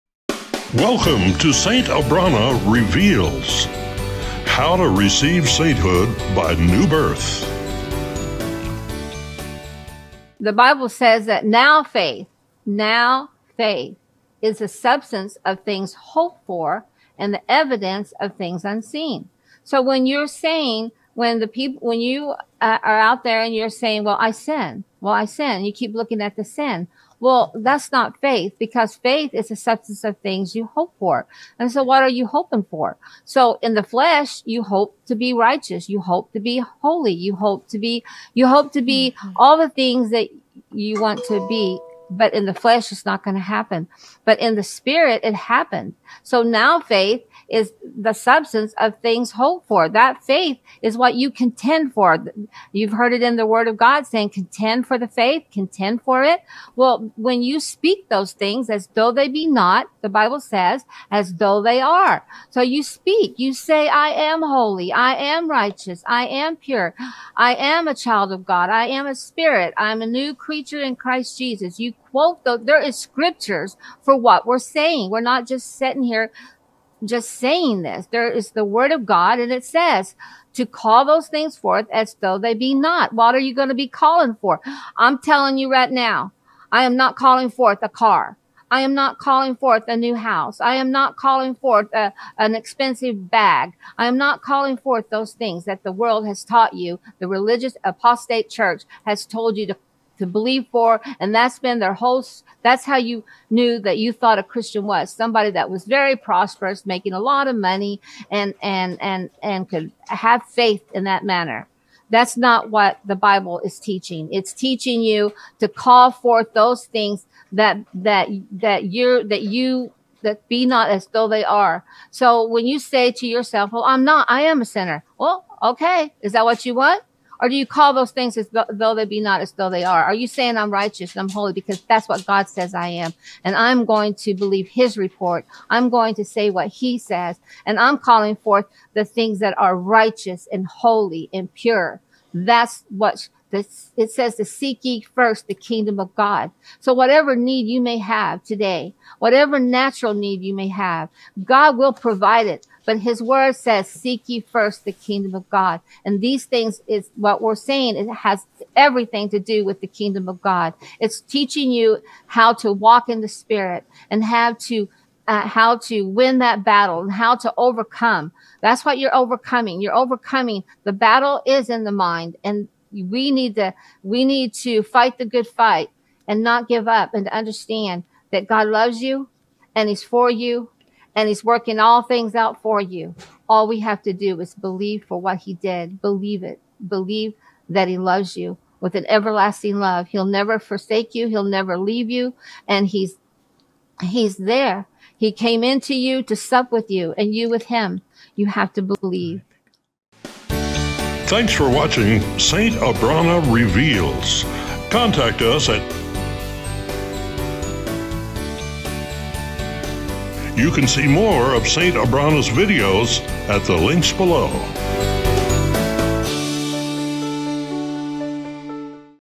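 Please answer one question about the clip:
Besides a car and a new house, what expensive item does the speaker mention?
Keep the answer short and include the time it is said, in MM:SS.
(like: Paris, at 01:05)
an expensive bag, at 01:32.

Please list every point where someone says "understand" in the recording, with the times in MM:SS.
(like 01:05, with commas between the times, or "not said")
02:57.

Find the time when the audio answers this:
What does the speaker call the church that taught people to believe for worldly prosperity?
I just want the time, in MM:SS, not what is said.
01:37.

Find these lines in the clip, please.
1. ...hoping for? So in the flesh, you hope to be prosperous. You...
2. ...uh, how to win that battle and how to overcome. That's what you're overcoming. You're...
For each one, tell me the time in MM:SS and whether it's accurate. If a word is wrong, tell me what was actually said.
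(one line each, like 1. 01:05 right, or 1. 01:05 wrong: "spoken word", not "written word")
1. 00:32 wrong: "righteous", not "prosperous"
2. 02:45 right.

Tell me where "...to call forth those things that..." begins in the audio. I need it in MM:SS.
01:55.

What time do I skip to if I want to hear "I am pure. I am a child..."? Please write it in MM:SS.
01:06.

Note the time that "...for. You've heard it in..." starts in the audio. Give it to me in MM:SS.
00:51.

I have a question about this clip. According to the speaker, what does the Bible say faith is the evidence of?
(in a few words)
things unseen.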